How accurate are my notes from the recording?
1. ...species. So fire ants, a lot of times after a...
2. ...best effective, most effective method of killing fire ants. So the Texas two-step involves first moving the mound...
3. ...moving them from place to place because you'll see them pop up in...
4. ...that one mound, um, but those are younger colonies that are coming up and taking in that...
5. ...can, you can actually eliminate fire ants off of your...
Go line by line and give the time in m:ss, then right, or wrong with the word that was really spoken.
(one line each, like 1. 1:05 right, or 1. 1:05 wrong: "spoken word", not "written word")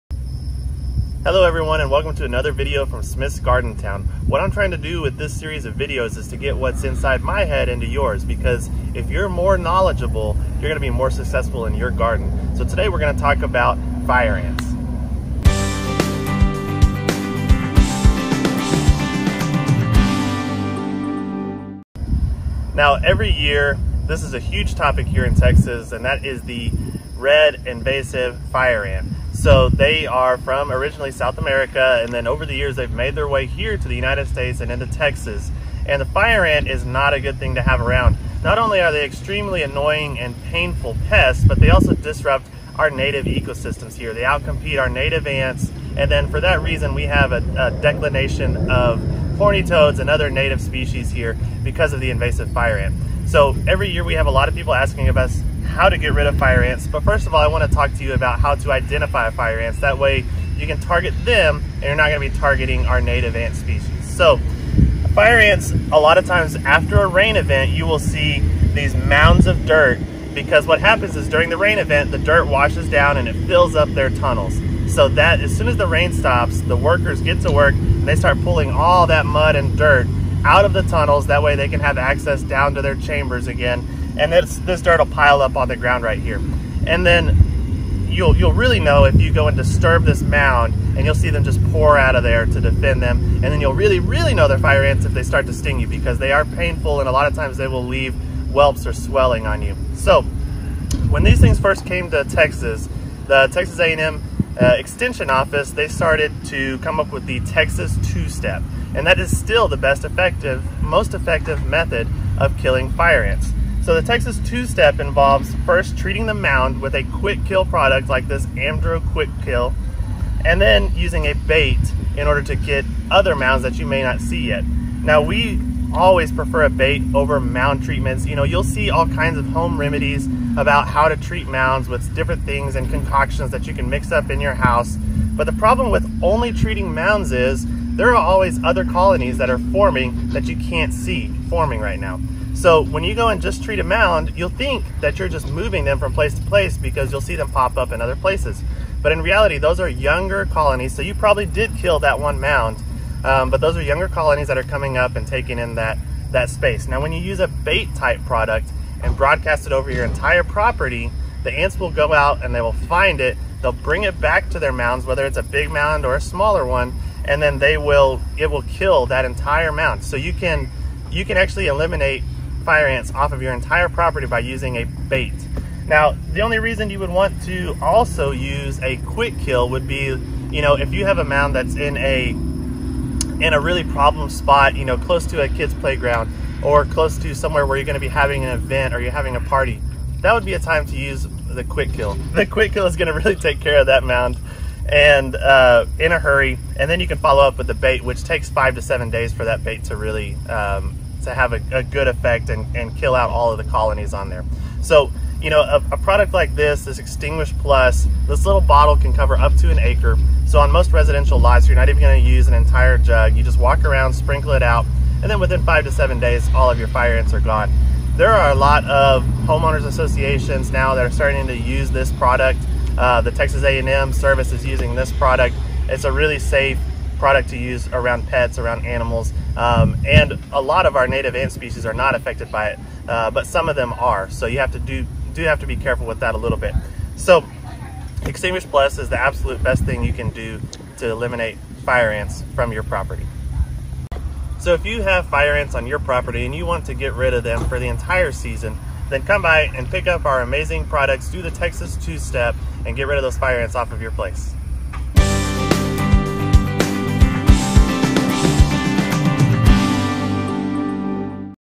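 1. 1:03 right
2. 1:49 wrong: "treating", not "moving"
3. 2:25 right
4. 2:31 right
5. 2:50 right.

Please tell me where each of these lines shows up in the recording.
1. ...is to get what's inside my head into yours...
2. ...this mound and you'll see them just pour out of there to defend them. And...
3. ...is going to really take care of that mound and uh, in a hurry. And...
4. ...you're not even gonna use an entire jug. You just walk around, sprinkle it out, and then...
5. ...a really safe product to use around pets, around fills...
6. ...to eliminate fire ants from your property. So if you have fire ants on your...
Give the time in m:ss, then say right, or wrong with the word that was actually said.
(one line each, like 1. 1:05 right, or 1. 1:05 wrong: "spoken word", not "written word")
1. 0:06 right
2. 1:30 right
3. 3:12 right
4. 3:31 right
5. 3:46 wrong: "animals", not "fills"
6. 4:00 right.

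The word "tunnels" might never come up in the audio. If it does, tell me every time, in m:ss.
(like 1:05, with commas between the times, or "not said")
1:14, 1:20.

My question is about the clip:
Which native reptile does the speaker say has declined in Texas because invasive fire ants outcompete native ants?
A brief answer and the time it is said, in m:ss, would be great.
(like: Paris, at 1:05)
Horny toads, at 0:49.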